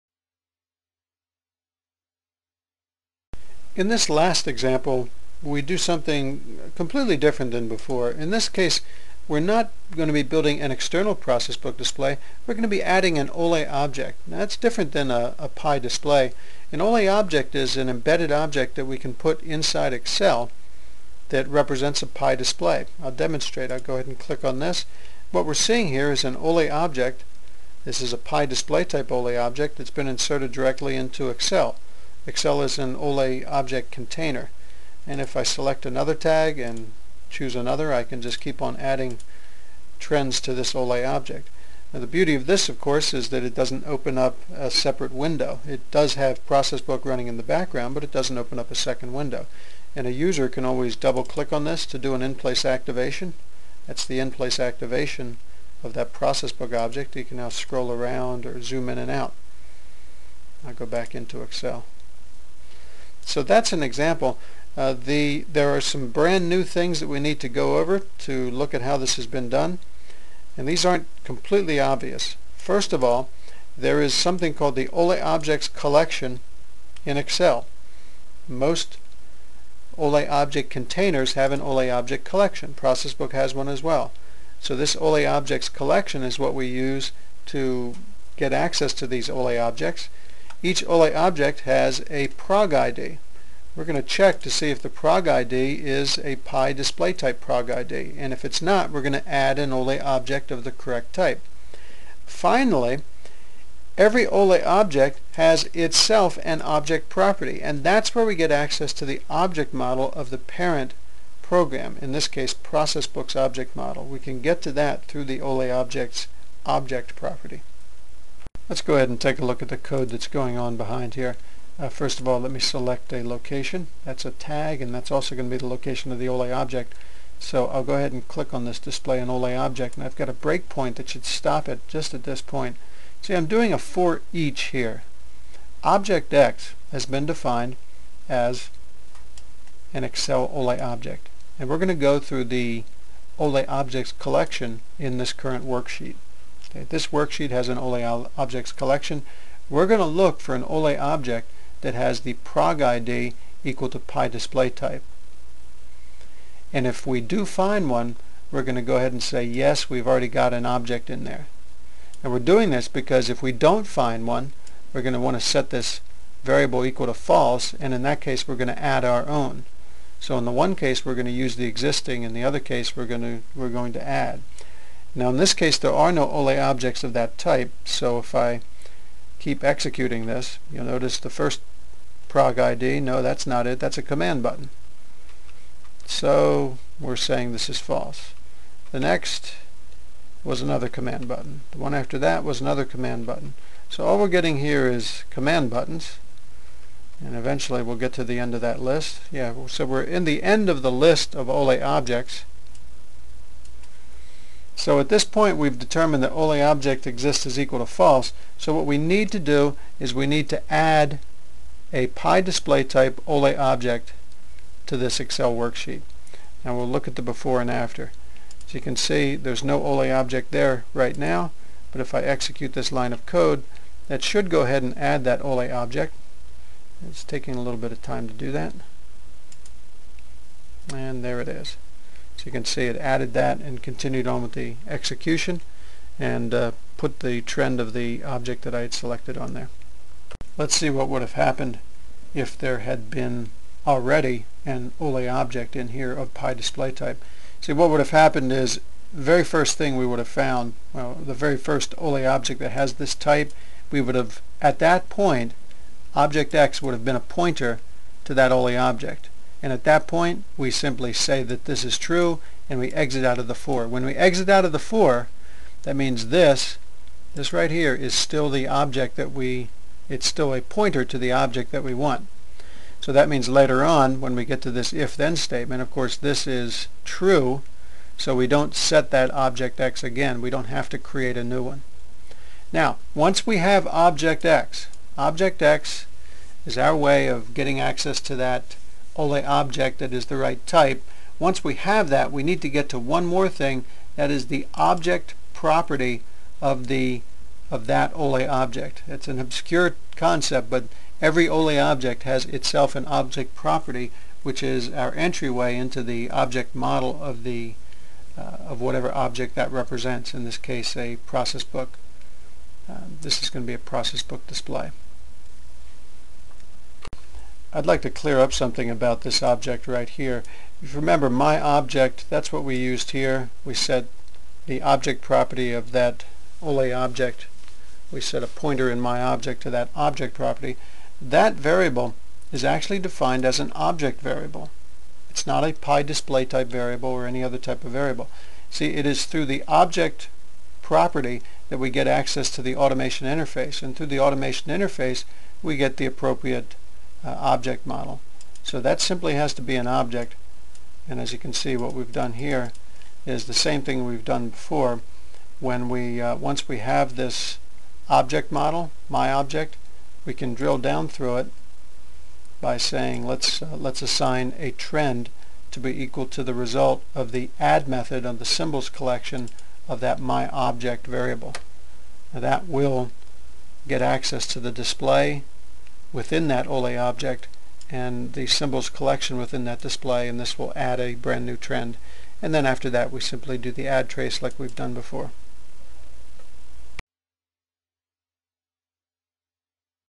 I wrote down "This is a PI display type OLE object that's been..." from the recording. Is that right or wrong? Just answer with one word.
right.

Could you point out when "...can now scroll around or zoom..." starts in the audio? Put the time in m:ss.
0:57.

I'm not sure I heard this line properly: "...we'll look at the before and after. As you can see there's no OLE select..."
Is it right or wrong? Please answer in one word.
wrong.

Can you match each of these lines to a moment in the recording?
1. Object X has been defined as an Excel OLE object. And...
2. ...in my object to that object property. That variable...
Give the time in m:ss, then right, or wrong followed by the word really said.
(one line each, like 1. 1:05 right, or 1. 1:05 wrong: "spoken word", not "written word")
1. 2:15 right
2. 5:28 right.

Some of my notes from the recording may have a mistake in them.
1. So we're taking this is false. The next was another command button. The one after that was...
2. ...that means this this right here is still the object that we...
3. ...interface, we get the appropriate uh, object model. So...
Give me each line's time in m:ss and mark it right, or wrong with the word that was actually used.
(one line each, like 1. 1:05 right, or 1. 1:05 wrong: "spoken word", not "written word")
1. 3:06 wrong: "saying", not "taking"
2. 4:25 right
3. 5:44 right.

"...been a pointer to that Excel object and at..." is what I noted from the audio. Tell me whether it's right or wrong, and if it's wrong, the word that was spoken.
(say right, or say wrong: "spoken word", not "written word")
wrong: "OLE", not "Excel".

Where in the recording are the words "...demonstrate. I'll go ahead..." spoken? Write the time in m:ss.
0:23.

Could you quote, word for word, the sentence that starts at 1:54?
We can get to that through the OLE objects object property.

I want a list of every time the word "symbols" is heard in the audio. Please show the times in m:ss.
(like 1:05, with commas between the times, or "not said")
6:08, 6:18.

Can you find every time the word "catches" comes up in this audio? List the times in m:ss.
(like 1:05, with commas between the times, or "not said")
not said.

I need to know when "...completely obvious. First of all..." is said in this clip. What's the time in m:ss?
1:11.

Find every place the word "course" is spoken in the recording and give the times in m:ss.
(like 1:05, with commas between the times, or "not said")
0:42, 4:35.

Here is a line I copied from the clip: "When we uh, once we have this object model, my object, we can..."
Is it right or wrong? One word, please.
right.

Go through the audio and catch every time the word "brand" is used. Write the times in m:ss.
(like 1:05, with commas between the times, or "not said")
1:06, 6:21.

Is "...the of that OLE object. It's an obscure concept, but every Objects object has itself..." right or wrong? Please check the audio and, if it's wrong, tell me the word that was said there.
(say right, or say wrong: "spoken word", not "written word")
wrong: "OLE", not "Objects".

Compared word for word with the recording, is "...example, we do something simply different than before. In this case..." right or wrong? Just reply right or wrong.
wrong.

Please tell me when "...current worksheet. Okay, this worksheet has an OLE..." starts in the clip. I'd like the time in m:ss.
2:25.